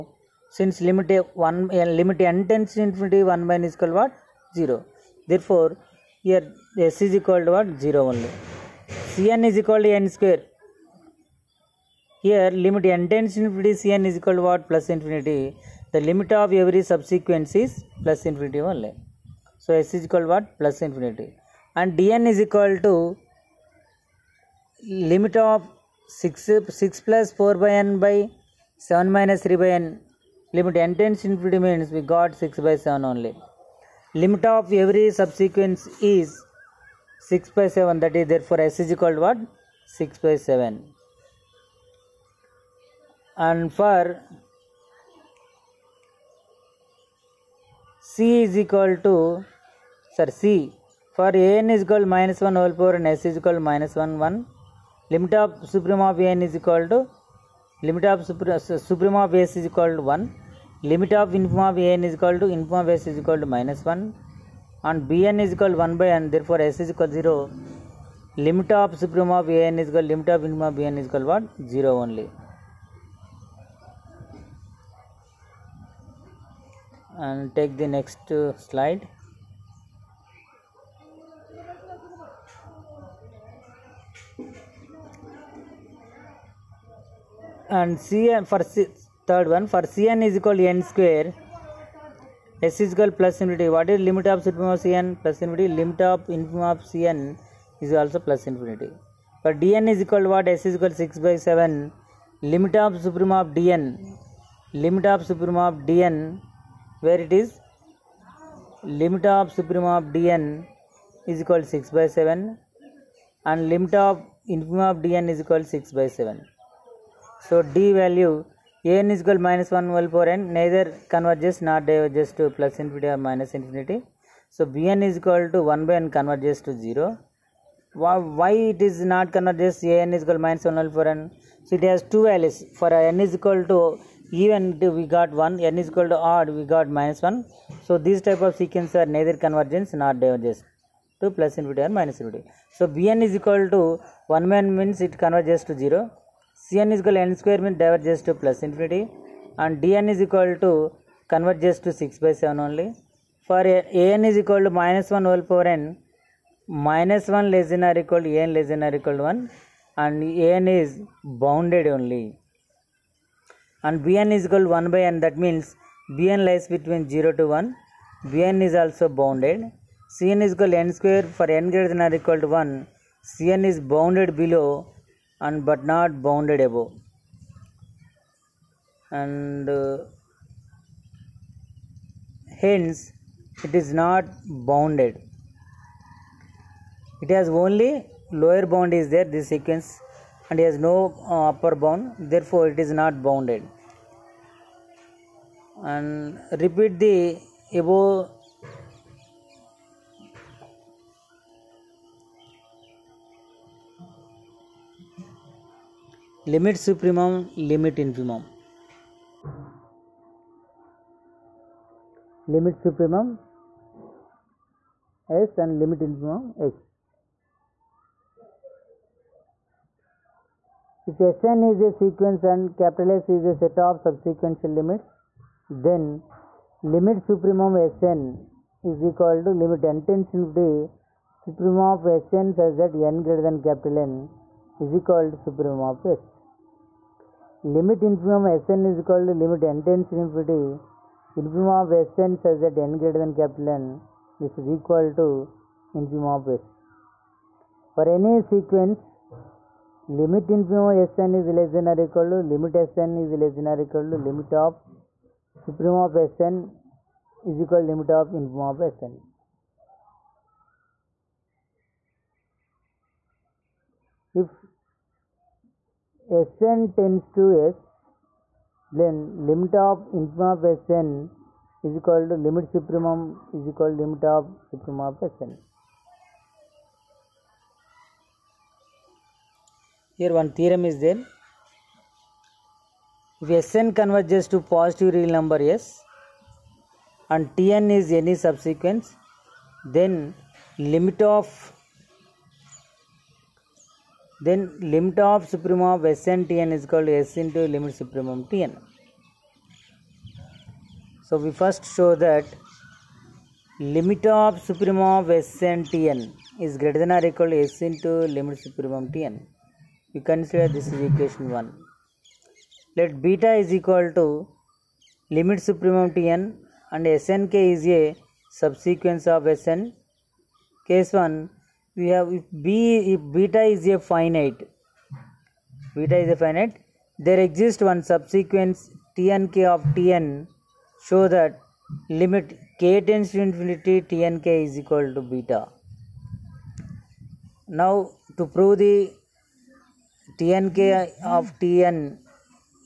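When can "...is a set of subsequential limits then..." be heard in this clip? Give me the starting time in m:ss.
3:43.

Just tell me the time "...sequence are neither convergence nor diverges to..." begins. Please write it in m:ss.
2:18.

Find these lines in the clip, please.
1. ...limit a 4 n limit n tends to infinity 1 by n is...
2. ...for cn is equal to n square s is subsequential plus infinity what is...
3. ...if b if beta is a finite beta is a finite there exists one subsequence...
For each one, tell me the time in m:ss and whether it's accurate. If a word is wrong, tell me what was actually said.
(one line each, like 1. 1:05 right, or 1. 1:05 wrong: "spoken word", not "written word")
1. 0:00 wrong: "1", not "4"
2. 1:29 wrong: "equal", not "subsequential"
3. 5:22 right.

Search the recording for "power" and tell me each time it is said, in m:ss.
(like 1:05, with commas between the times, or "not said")
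0:52, 2:35.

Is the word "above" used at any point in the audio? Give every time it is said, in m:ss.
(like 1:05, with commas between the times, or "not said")
2:56, 3:17.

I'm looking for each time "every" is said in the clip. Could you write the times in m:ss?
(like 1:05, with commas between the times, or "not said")
0:16, 0:34.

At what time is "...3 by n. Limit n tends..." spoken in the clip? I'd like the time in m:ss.
0:29.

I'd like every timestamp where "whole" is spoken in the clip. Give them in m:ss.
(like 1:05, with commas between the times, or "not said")
0:52, 2:35.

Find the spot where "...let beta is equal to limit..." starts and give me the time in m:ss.
5:13.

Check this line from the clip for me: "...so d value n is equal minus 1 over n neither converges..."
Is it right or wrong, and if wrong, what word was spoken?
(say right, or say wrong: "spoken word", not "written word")
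right.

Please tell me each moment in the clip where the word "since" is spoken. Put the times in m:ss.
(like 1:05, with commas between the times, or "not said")
0:00.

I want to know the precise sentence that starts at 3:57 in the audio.
Limit infimum Sn is equal to limit n tends to infinity.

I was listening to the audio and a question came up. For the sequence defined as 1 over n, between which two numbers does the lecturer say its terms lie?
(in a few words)
0 to 1.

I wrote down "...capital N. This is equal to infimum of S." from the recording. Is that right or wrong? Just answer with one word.
right.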